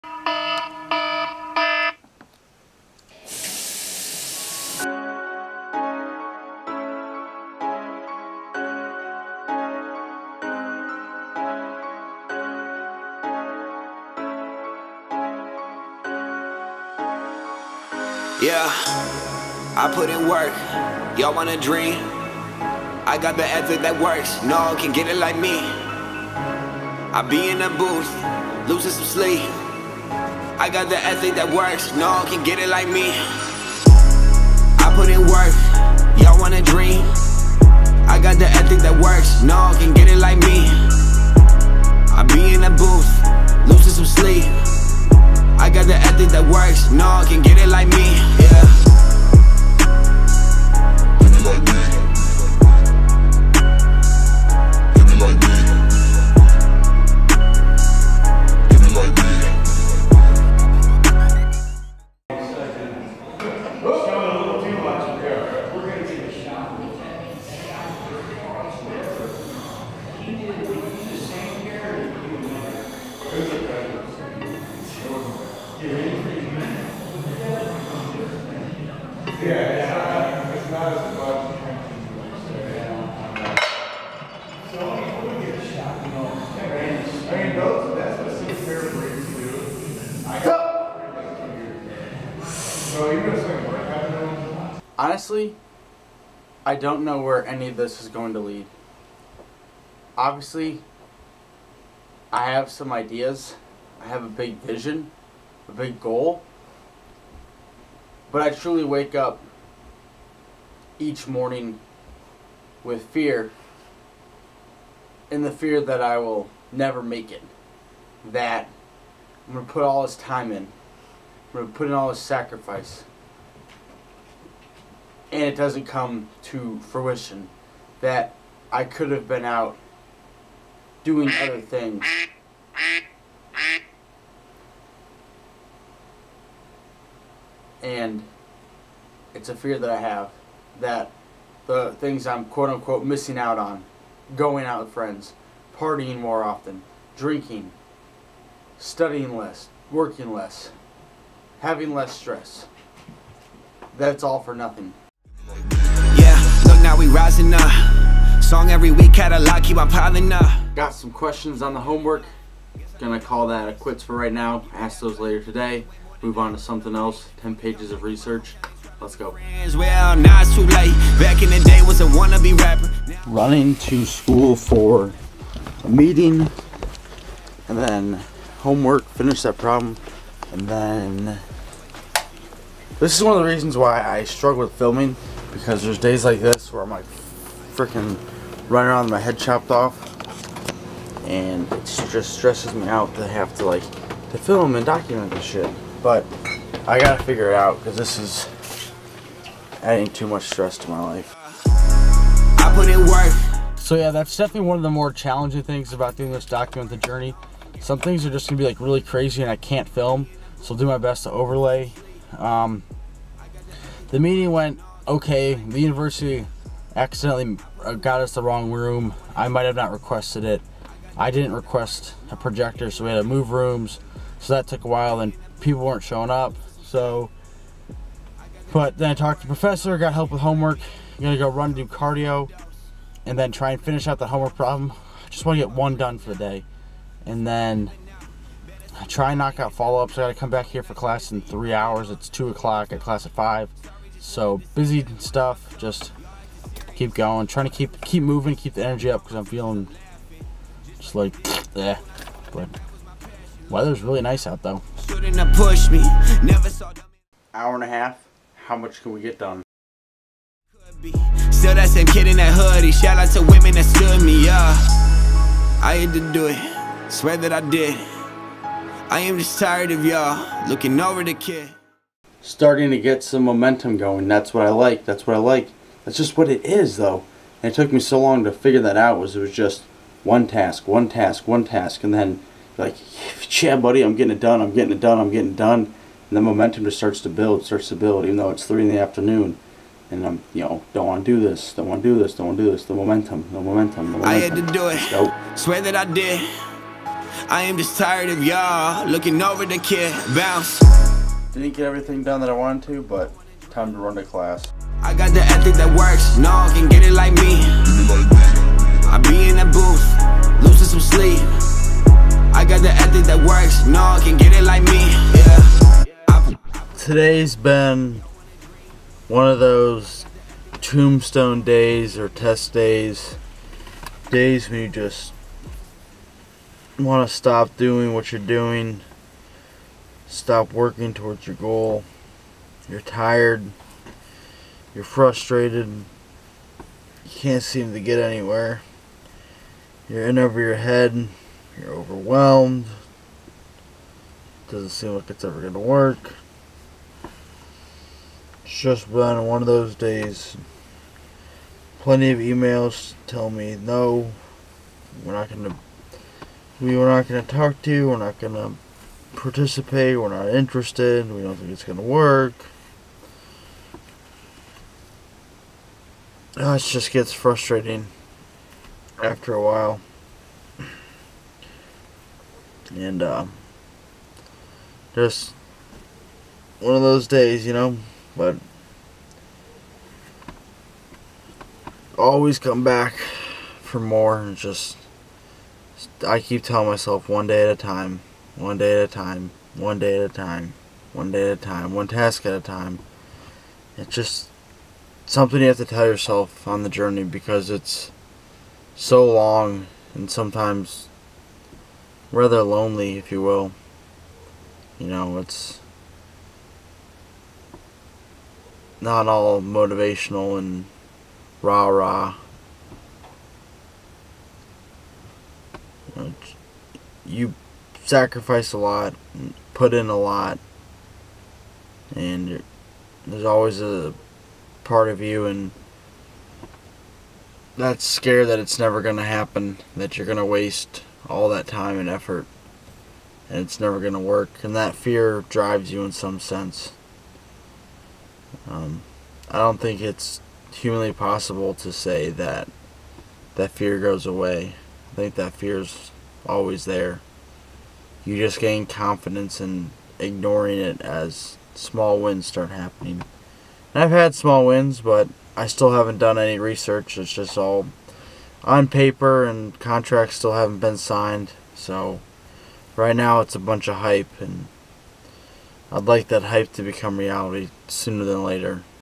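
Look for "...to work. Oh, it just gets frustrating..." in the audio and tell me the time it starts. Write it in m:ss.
6:01.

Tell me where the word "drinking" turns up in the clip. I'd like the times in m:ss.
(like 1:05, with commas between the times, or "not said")
2:27.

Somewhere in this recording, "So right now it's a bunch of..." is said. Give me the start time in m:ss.
7:41.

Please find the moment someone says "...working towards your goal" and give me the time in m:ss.
5:30.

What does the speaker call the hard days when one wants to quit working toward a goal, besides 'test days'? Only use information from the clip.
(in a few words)
tombstone days.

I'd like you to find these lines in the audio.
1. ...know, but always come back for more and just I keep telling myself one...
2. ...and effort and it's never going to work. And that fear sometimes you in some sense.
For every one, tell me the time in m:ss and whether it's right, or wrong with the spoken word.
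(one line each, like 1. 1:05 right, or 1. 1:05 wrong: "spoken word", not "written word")
1. 6:17 right
2. 7:11 wrong: "drives", not "sometimes".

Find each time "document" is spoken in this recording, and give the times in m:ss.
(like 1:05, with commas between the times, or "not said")
3:14, 3:26.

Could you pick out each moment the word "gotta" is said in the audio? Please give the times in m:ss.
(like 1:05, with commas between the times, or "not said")
3:16, 4:00.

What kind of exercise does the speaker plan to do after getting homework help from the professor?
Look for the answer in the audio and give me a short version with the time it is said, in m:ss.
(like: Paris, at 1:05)
cardio, at 3:51.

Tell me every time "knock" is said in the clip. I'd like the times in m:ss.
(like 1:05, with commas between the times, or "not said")
3:59.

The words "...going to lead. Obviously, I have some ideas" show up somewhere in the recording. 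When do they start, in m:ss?
1:38.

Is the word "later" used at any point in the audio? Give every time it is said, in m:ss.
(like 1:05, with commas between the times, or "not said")
2:45, 7:48.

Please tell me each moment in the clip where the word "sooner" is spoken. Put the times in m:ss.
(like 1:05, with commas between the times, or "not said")
7:47.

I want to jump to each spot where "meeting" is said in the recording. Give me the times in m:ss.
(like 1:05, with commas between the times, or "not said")
2:55, 3:34.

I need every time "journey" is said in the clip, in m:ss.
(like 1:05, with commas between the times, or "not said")
3:26, 6:36.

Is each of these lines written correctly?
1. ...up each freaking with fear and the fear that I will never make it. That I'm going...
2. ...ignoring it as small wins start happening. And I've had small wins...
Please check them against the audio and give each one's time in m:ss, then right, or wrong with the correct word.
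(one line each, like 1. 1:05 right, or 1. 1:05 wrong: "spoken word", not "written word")
1. 1:49 wrong: "morning", not "freaking"
2. 7:30 right.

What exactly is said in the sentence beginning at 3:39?
I might have not requested it.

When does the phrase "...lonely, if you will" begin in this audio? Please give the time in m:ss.
6:42.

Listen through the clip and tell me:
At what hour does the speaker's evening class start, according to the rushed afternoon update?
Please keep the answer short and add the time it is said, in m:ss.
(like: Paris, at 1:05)
5, at 4:03.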